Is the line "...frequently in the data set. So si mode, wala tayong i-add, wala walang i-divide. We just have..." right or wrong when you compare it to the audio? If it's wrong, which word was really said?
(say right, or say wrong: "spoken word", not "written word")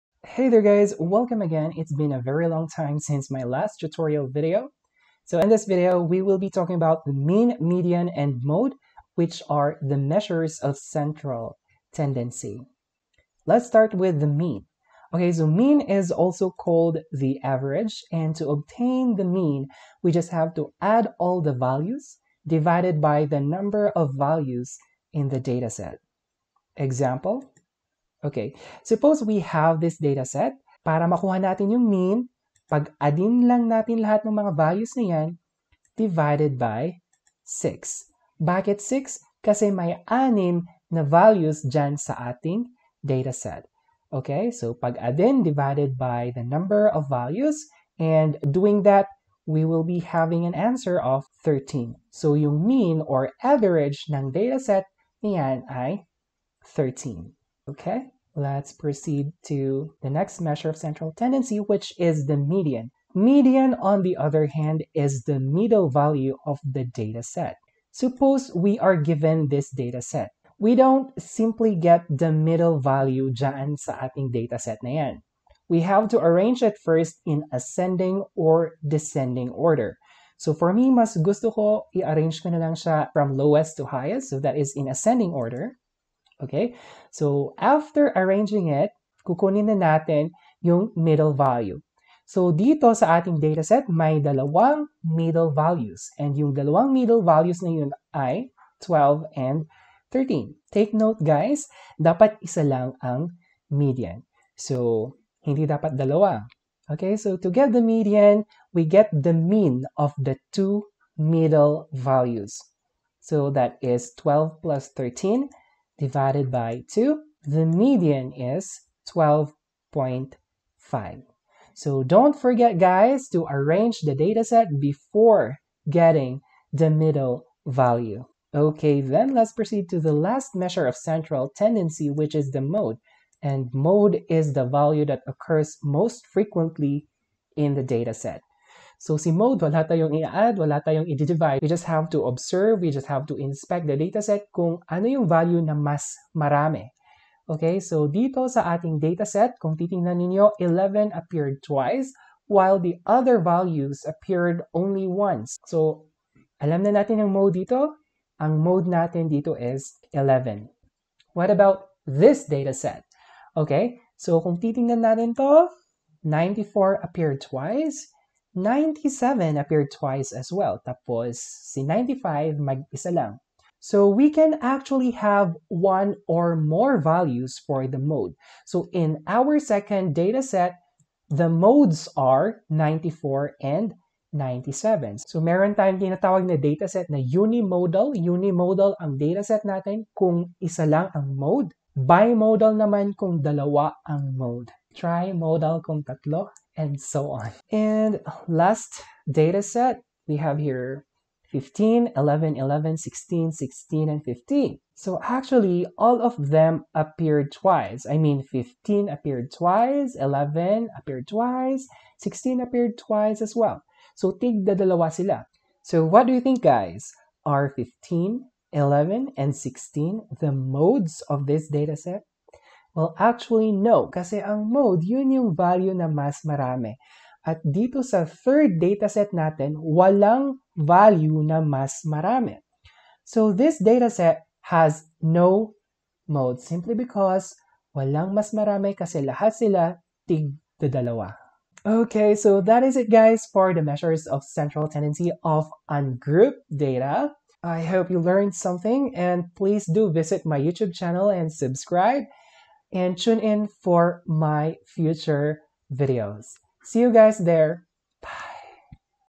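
wrong: "tayong", not "walang".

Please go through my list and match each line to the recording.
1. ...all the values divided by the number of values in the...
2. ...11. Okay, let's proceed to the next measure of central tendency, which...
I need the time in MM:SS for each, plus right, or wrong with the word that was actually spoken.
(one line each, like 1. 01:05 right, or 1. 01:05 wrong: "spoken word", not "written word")
1. 00:21 right
2. 00:56 wrong: "13", not "11".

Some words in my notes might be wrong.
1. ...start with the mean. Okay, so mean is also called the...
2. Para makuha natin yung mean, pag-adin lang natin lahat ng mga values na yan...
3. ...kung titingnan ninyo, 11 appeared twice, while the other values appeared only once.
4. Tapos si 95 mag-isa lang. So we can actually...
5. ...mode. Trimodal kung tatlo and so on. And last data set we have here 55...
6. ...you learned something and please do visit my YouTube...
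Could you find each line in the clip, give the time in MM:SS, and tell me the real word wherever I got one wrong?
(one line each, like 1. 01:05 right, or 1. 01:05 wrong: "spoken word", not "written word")
1. 00:13 right
2. 00:30 right
3. 02:29 right
4. 02:50 right
5. 03:14 wrong: "15", not "55"
6. 04:08 right.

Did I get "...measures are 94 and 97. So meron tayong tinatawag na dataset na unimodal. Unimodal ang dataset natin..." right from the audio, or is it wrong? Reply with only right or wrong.
wrong.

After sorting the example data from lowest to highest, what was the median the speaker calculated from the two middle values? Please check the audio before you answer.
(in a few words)
12.5.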